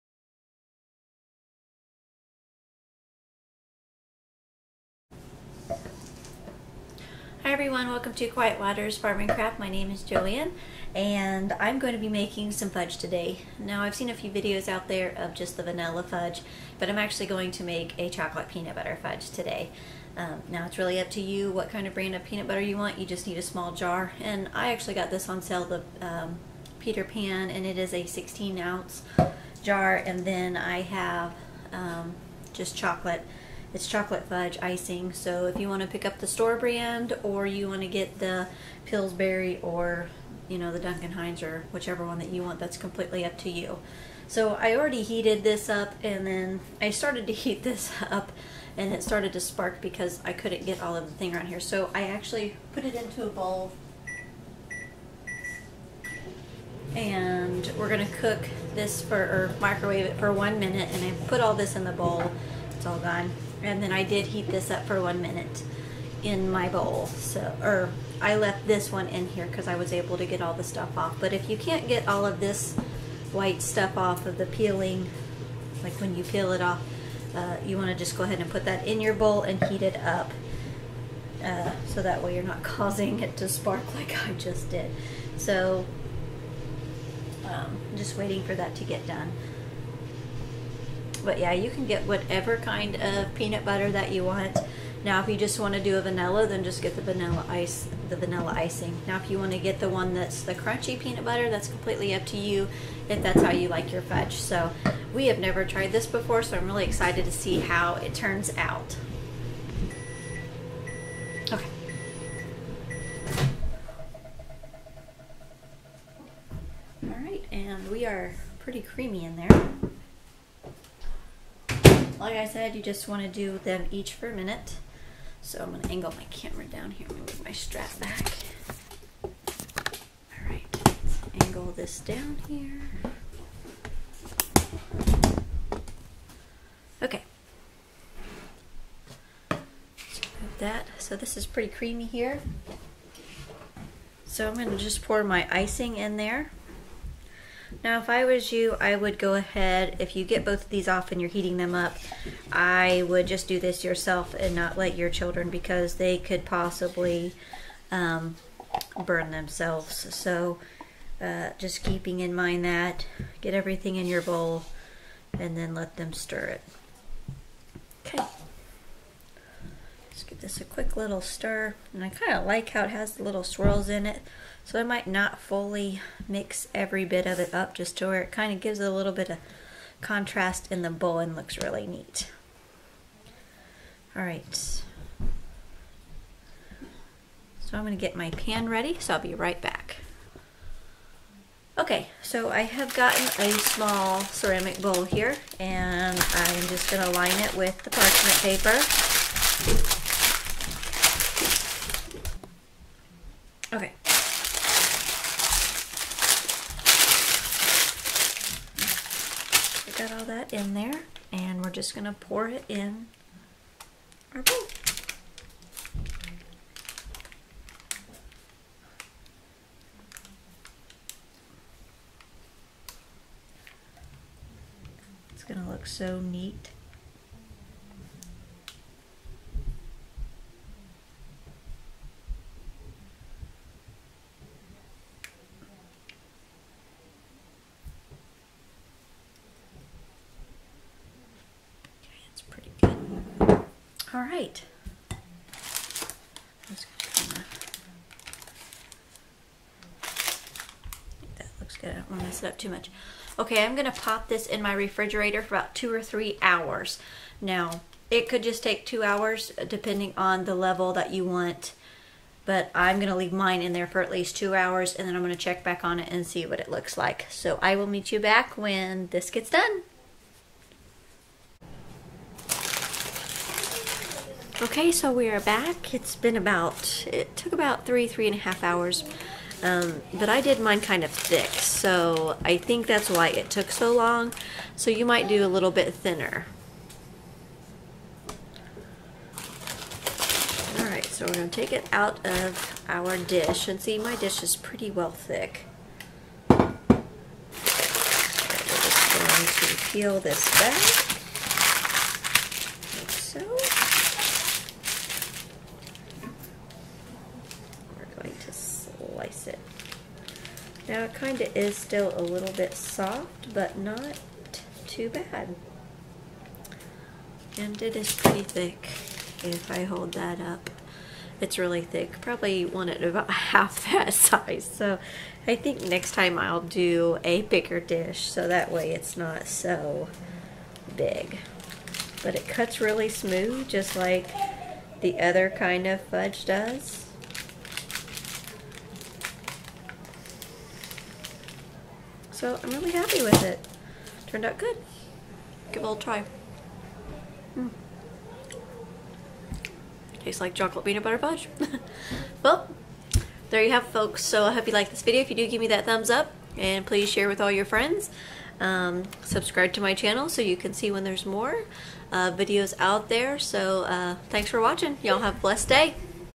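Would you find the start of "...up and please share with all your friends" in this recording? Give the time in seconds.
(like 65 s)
356 s.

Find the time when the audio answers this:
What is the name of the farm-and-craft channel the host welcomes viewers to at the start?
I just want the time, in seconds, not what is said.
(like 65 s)
8 s.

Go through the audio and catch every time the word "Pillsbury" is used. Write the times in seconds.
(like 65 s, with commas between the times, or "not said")
38 s.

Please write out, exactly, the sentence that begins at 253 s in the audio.
Okay, I'm going to pop this in my refrigerator for about two or three hours.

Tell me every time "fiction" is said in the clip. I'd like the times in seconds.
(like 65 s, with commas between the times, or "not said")
not said.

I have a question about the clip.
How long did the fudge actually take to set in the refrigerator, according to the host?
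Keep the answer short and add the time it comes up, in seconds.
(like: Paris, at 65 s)
3 and a half hours, at 277 s.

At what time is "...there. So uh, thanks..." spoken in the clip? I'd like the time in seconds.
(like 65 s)
363 s.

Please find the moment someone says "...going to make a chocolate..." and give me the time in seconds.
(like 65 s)
17 s.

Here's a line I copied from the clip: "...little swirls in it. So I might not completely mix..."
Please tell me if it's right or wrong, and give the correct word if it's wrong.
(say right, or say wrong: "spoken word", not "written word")
wrong: "fully", not "completely".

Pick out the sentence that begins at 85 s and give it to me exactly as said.
So um, just waiting for that to get done.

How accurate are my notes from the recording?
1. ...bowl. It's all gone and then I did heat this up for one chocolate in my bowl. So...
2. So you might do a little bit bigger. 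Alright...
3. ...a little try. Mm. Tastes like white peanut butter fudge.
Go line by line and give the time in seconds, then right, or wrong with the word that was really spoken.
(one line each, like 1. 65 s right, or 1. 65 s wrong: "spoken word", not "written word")
1. 61 s wrong: "minute", not "chocolate"
2. 284 s wrong: "thinner", not "bigger"
3. 345 s wrong: "chocolate", not "white".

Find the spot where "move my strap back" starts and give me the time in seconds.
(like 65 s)
127 s.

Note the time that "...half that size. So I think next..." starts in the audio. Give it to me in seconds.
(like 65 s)
323 s.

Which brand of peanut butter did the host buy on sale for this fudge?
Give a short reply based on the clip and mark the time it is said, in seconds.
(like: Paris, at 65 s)
Peter Pan, at 26 s.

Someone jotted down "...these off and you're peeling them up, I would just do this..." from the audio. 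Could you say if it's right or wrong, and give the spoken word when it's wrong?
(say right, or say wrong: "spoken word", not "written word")
wrong: "heating", not "peeling".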